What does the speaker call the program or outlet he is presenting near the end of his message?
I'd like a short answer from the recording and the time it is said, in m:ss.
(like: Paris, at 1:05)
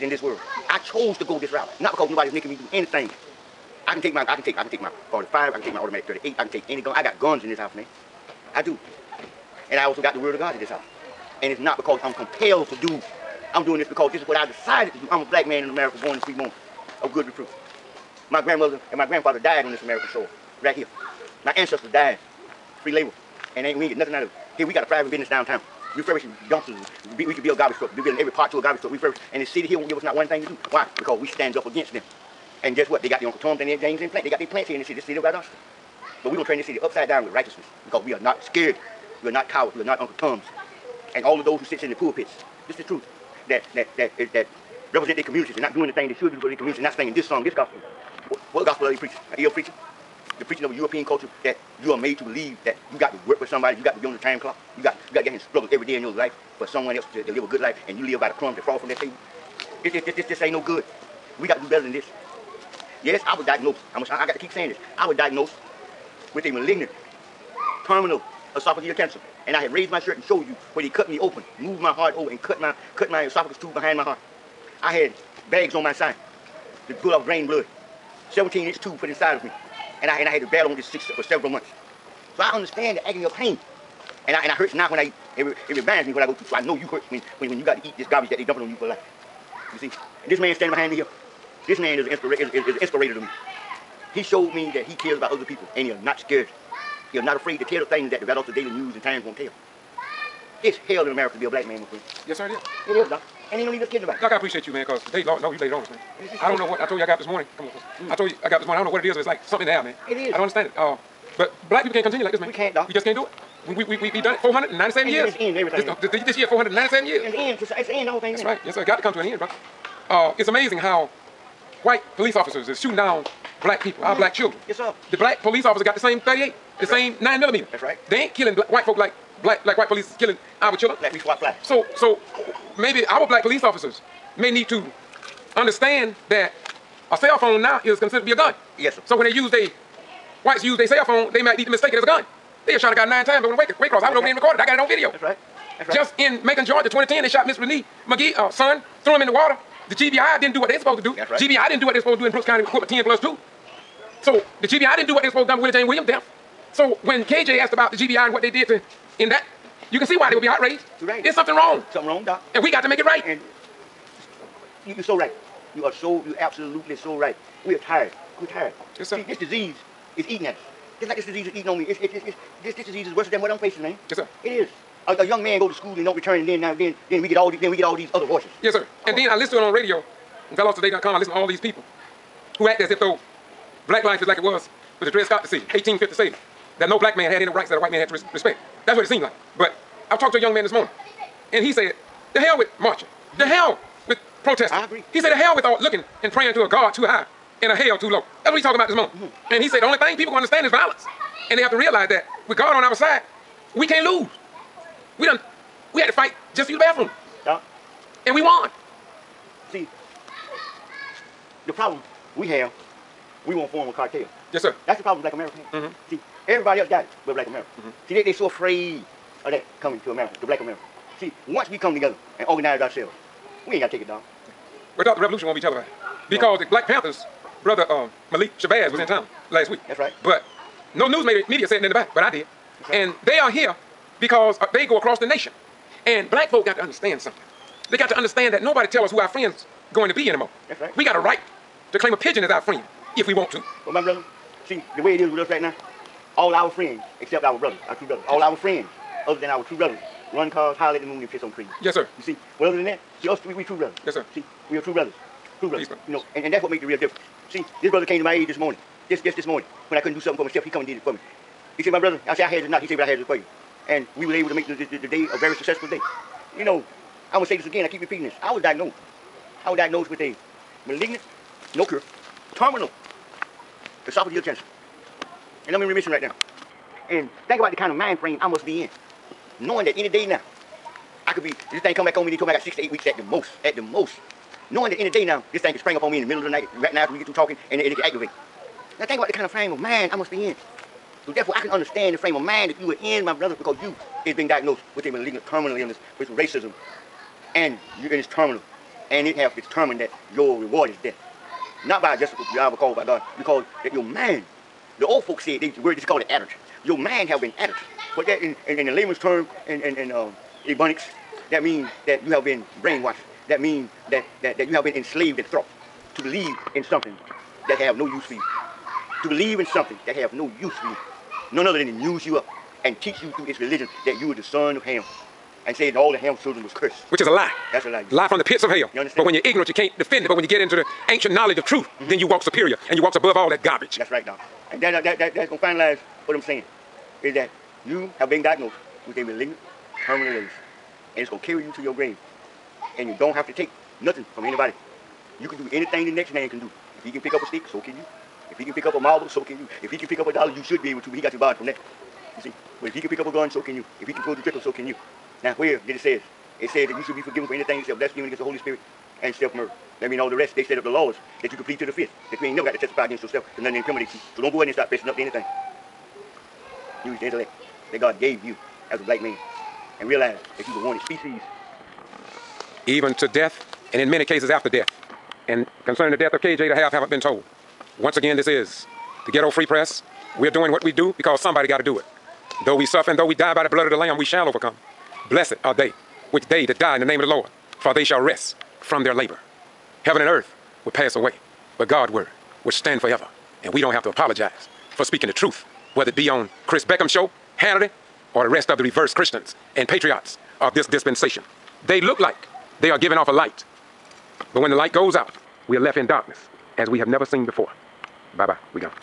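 Ghetto Free Press, at 6:19.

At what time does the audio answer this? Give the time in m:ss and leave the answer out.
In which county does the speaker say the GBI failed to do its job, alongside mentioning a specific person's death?
2:32.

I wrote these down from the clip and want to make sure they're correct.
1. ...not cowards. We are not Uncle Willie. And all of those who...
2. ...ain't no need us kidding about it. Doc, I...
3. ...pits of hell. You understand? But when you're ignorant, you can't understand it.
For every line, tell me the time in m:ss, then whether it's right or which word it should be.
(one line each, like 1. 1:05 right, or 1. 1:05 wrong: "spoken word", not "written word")
1. 0:39 wrong: "Toms", not "Willie"
2. 1:43 right
3. 5:28 wrong: "defend", not "understand".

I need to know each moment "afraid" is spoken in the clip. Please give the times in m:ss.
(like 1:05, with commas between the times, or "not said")
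1:37, 3:38.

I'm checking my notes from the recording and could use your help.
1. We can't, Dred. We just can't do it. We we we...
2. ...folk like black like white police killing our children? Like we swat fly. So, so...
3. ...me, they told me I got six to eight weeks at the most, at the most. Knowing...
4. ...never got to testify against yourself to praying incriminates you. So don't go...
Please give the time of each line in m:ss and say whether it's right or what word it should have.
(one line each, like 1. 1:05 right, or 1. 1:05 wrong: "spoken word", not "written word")
1. 1:52 wrong: "Doc", not "Dred"
2. 2:08 right
3. 4:42 right
4. 6:02 wrong: "nothing", not "praying".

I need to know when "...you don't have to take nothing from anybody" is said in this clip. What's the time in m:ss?
5:43.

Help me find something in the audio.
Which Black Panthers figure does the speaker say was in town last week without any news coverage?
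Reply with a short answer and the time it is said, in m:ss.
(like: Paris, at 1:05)
Malik Shabazz, at 3:48.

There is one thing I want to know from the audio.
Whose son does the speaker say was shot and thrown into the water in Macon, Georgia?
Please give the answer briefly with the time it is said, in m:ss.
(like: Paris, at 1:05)
Renee McGee, at 2:27.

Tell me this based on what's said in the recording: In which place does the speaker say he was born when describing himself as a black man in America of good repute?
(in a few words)
Fremont.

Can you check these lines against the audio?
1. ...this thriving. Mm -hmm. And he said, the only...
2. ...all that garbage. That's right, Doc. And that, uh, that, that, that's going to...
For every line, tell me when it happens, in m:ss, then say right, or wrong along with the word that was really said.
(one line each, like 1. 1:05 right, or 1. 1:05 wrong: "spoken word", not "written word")
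1. 3:18 wrong: "morning", not "thriving"
2. 5:33 right.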